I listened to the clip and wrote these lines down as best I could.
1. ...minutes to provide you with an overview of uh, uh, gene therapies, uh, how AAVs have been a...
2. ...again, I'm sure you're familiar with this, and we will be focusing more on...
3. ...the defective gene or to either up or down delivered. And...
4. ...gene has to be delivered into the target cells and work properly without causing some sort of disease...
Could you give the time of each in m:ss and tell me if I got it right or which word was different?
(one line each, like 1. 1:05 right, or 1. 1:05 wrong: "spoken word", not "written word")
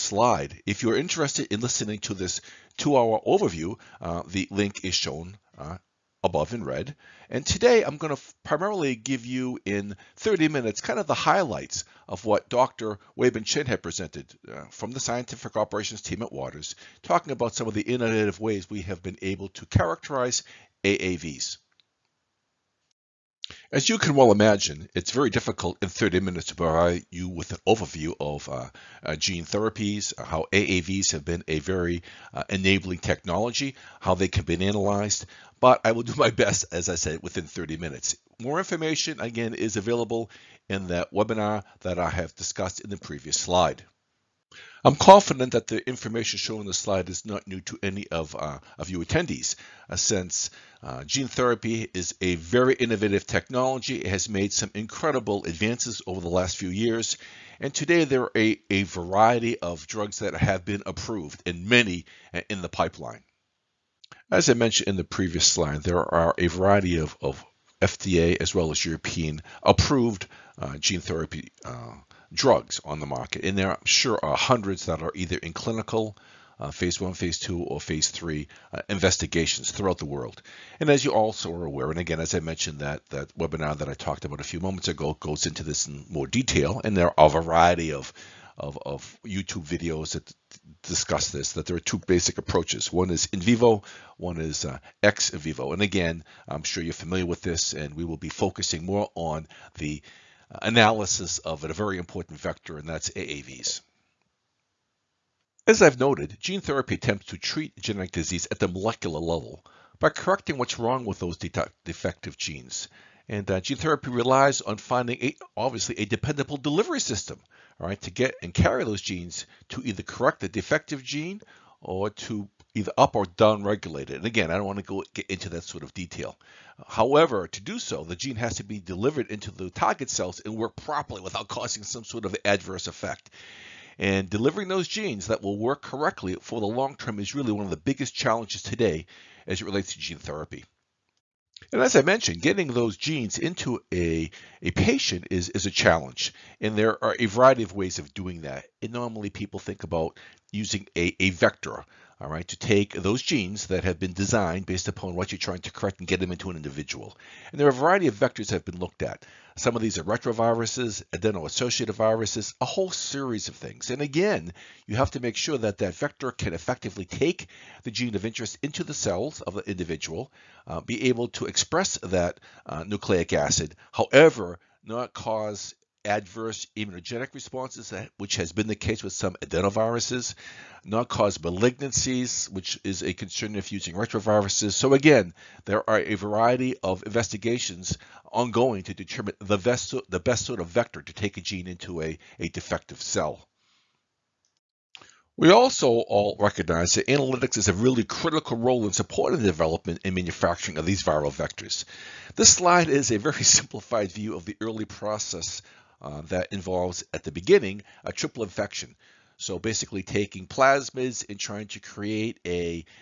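1. 0:26 right
2. 1:35 right
3. 2:00 wrong: "regulated", not "delivered"
4. 2:08 wrong: "adverse", not "disease".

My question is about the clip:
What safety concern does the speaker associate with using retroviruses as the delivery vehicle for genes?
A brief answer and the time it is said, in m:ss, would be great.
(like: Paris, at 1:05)
malignancies, at 3:01.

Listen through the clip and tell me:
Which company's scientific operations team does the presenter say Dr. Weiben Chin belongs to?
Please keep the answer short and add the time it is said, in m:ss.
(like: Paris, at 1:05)
Waters, at 0:16.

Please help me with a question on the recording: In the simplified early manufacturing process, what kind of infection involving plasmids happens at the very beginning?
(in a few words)
triple infection.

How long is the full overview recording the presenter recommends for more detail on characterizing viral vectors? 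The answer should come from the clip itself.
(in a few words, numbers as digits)
2 hours.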